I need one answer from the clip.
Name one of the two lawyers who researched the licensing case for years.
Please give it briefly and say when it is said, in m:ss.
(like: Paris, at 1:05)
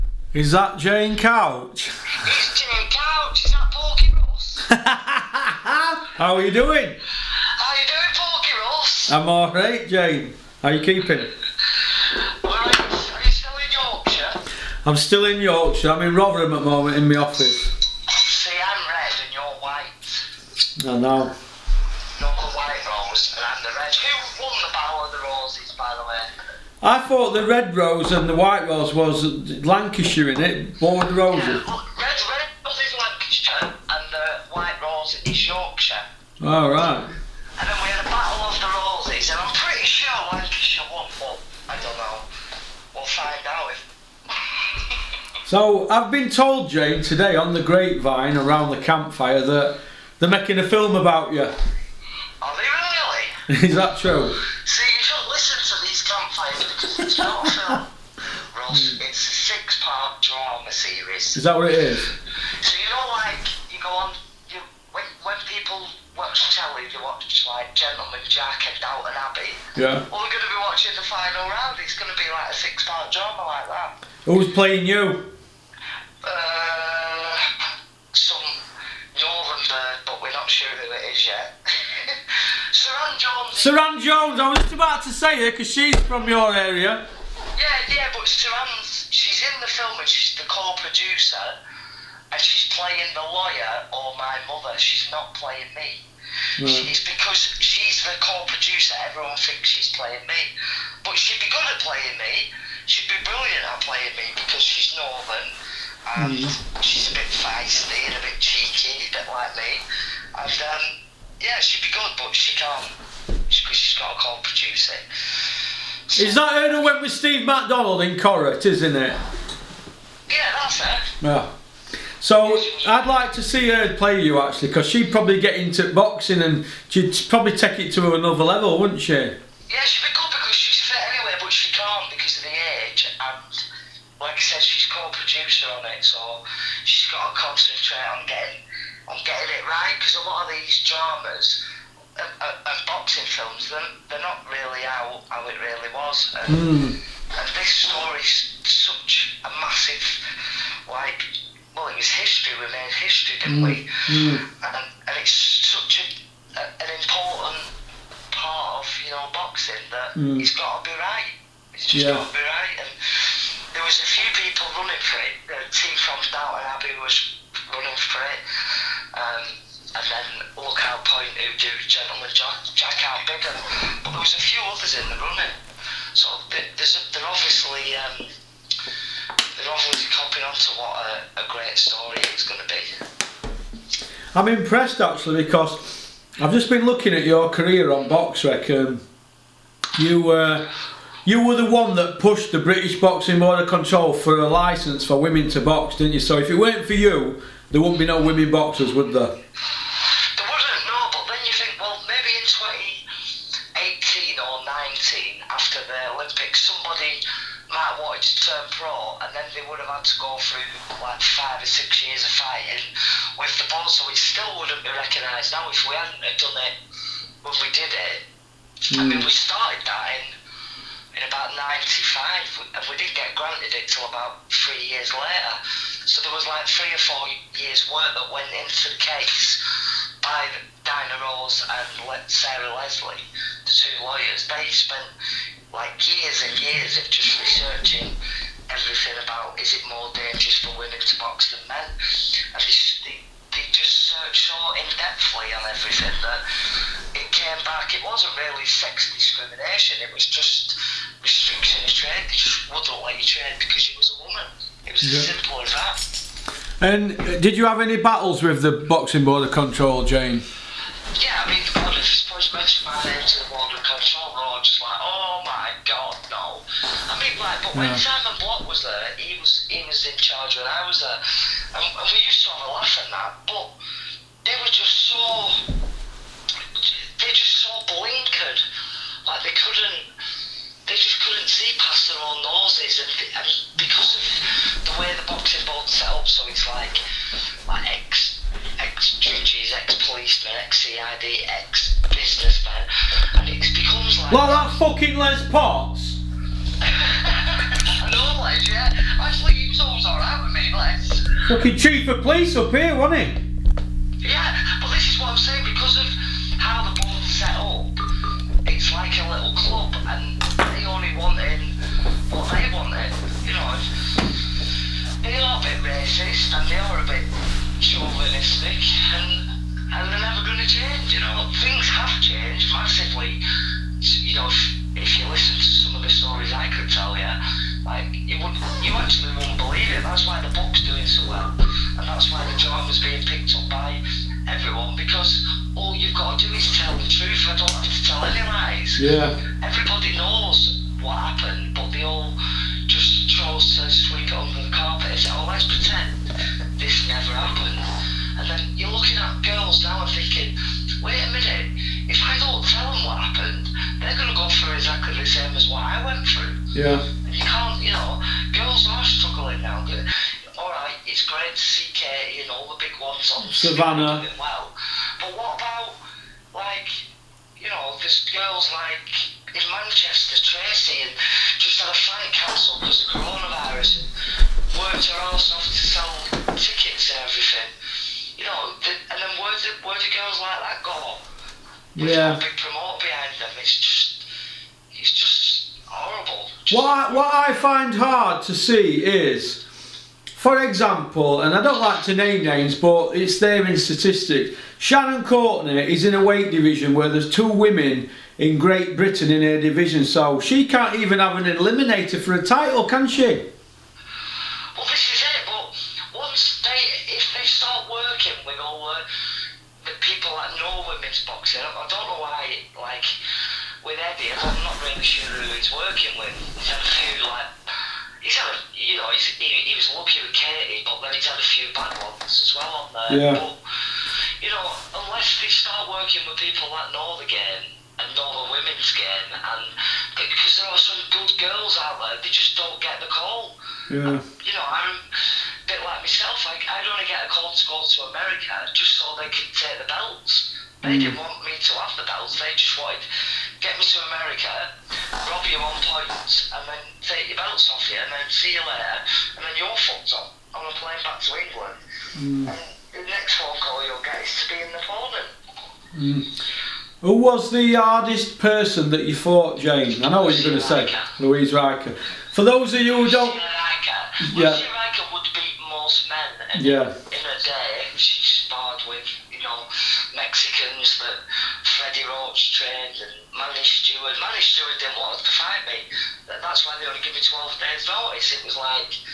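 Dinah Rose, at 3:50.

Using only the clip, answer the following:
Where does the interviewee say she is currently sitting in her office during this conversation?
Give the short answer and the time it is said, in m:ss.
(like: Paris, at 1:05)
Rotherham, at 0:16.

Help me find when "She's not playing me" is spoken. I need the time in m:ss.
1:34.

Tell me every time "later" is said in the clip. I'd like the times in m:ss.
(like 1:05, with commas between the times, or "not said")
3:45, 7:28.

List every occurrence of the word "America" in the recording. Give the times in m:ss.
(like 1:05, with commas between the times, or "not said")
7:18, 7:24.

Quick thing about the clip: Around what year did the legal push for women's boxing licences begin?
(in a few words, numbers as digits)
1995.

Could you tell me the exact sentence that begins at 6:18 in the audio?
You know, the, and then where do, where do girls like that go?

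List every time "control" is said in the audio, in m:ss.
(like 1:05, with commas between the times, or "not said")
3:13, 4:19, 4:23.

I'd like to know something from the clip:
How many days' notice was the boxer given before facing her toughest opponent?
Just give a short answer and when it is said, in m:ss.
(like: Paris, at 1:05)
12, at 7:57.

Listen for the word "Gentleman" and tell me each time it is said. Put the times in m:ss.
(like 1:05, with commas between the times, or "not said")
1:07, 2:51.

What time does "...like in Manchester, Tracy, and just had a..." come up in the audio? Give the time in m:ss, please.
6:08.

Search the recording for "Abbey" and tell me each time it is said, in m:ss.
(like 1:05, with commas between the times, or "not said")
1:09, 2:46.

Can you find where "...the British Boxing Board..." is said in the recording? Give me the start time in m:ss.
3:12.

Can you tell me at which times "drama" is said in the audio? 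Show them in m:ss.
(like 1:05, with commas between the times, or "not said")
1:00, 1:13, 2:20.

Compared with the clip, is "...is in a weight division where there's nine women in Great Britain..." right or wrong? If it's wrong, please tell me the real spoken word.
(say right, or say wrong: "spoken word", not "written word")
wrong: "two", not "nine".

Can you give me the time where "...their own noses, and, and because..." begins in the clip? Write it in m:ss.
4:42.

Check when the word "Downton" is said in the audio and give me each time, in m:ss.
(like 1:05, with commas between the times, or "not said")
1:08, 2:46.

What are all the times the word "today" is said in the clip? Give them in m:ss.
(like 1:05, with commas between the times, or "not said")
0:47.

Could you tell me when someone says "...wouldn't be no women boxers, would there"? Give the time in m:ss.
3:17.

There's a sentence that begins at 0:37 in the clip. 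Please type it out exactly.
And then we had a battle of the roses, and I'm pretty sure Lancashire won, but I don't know.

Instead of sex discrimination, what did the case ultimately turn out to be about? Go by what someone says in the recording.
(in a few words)
Restriction of trade.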